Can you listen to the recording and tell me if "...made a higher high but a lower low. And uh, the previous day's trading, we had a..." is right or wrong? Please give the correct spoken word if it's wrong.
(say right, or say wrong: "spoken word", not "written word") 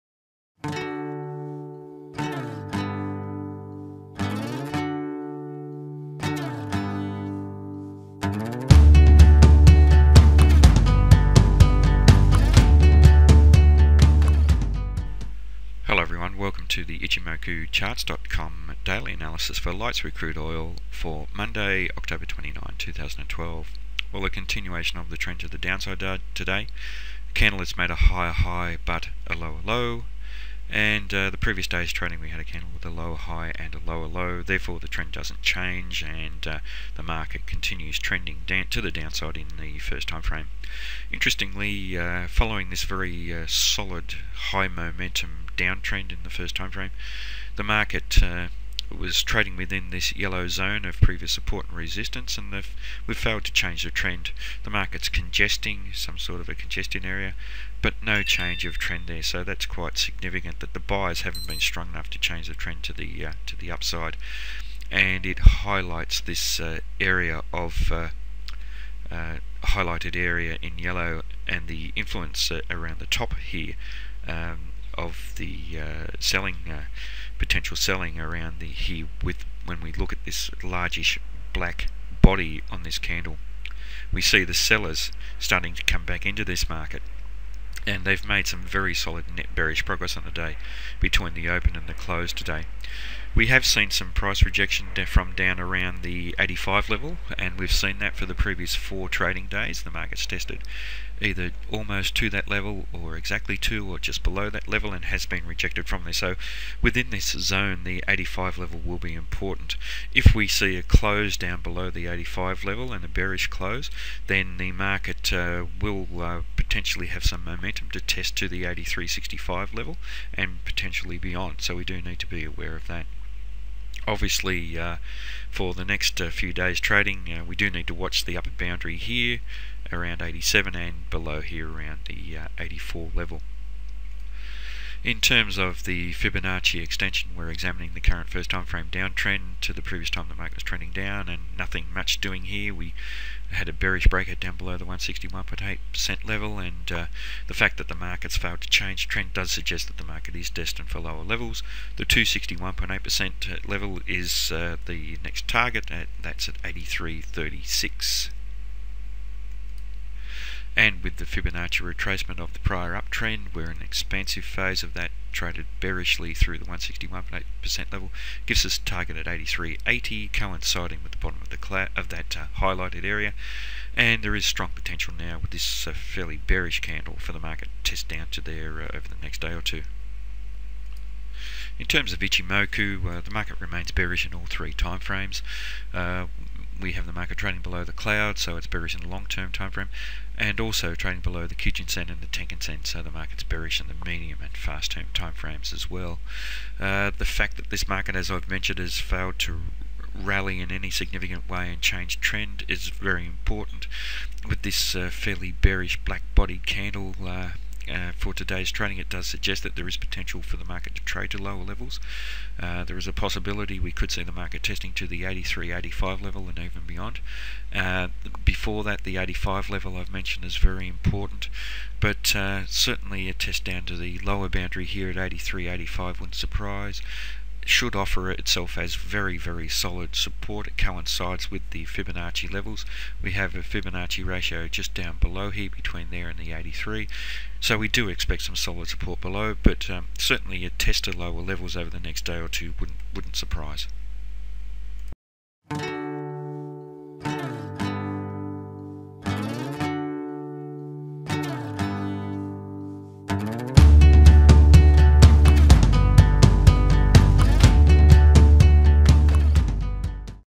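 right.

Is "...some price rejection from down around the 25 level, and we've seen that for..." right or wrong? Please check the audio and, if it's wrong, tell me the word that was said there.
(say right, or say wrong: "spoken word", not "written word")
wrong: "85", not "25".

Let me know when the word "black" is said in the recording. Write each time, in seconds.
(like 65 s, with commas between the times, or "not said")
81 s, 206 s.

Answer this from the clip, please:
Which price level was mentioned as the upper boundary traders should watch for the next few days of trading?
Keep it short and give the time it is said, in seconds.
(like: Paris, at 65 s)
87, at 130 s.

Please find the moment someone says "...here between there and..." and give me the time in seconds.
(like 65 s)
235 s.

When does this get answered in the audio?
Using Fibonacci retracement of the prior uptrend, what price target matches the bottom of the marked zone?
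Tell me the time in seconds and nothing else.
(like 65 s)
169 s.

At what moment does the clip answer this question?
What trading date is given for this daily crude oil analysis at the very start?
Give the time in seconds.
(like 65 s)
21 s.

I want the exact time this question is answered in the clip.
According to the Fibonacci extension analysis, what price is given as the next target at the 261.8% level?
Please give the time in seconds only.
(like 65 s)
156 s.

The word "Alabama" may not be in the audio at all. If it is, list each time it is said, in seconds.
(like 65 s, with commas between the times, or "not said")
not said.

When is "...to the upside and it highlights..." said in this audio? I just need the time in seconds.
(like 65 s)
63 s.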